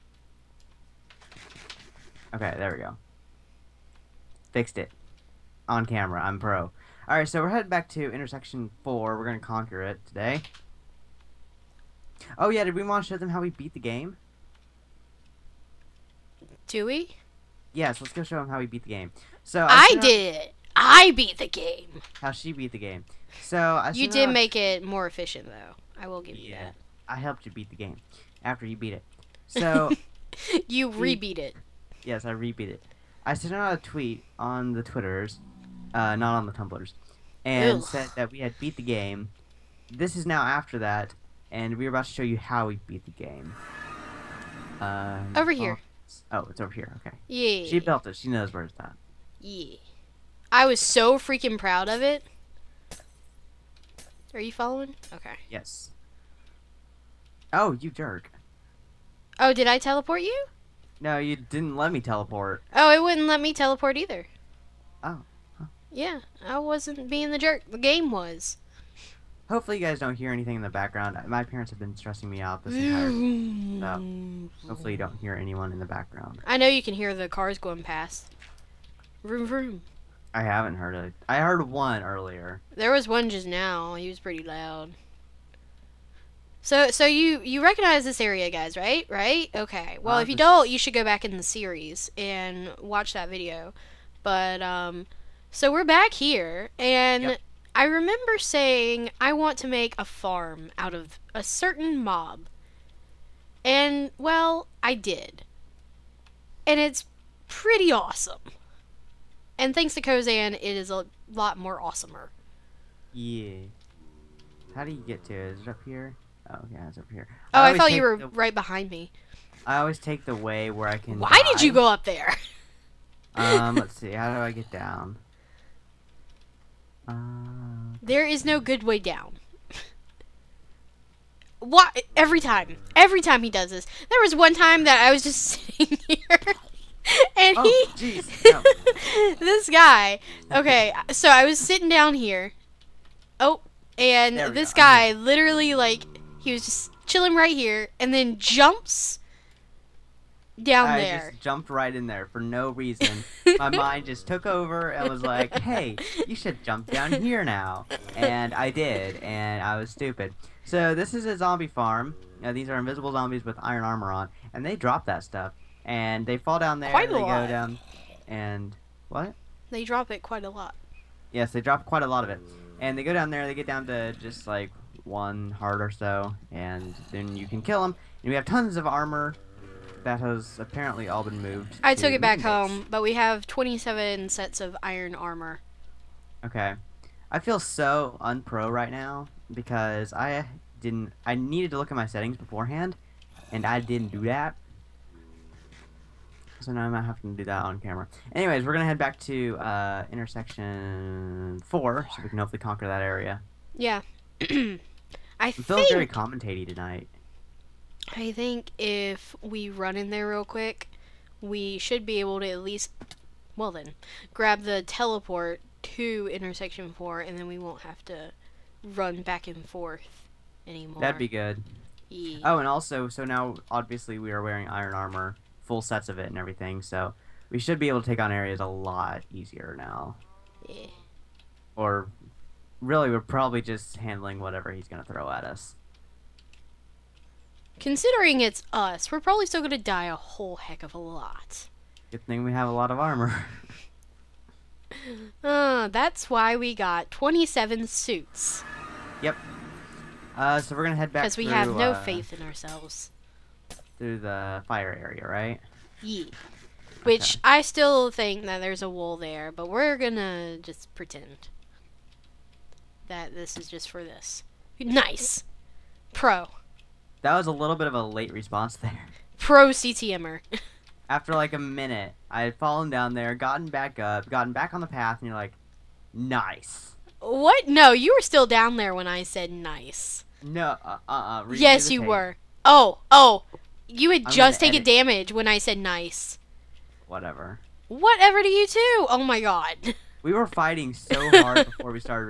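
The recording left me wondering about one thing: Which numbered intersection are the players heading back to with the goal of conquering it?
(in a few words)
Intersection 4.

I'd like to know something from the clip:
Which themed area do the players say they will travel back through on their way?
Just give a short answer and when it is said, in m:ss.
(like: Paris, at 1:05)
The fire area, at 4:14.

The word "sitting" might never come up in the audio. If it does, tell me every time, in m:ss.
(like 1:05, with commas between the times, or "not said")
2:15, 2:21.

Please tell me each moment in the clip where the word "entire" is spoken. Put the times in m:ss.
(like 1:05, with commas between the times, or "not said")
1:12.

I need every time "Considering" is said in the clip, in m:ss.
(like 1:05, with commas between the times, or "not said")
3:57.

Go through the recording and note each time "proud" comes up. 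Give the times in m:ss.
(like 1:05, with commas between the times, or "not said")
0:51.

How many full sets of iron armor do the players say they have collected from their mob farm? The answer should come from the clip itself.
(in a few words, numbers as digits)
27.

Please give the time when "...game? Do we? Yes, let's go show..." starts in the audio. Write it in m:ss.
0:13.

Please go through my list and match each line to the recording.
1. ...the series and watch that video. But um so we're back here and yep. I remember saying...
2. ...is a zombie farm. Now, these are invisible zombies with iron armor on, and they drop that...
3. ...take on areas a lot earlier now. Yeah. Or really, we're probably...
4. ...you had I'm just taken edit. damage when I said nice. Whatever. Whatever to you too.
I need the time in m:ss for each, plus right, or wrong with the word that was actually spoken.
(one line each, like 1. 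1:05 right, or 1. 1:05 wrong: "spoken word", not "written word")
1. 1:31 right
2. 2:41 right
3. 3:48 wrong: "easier", not "earlier"
4. 4:43 right.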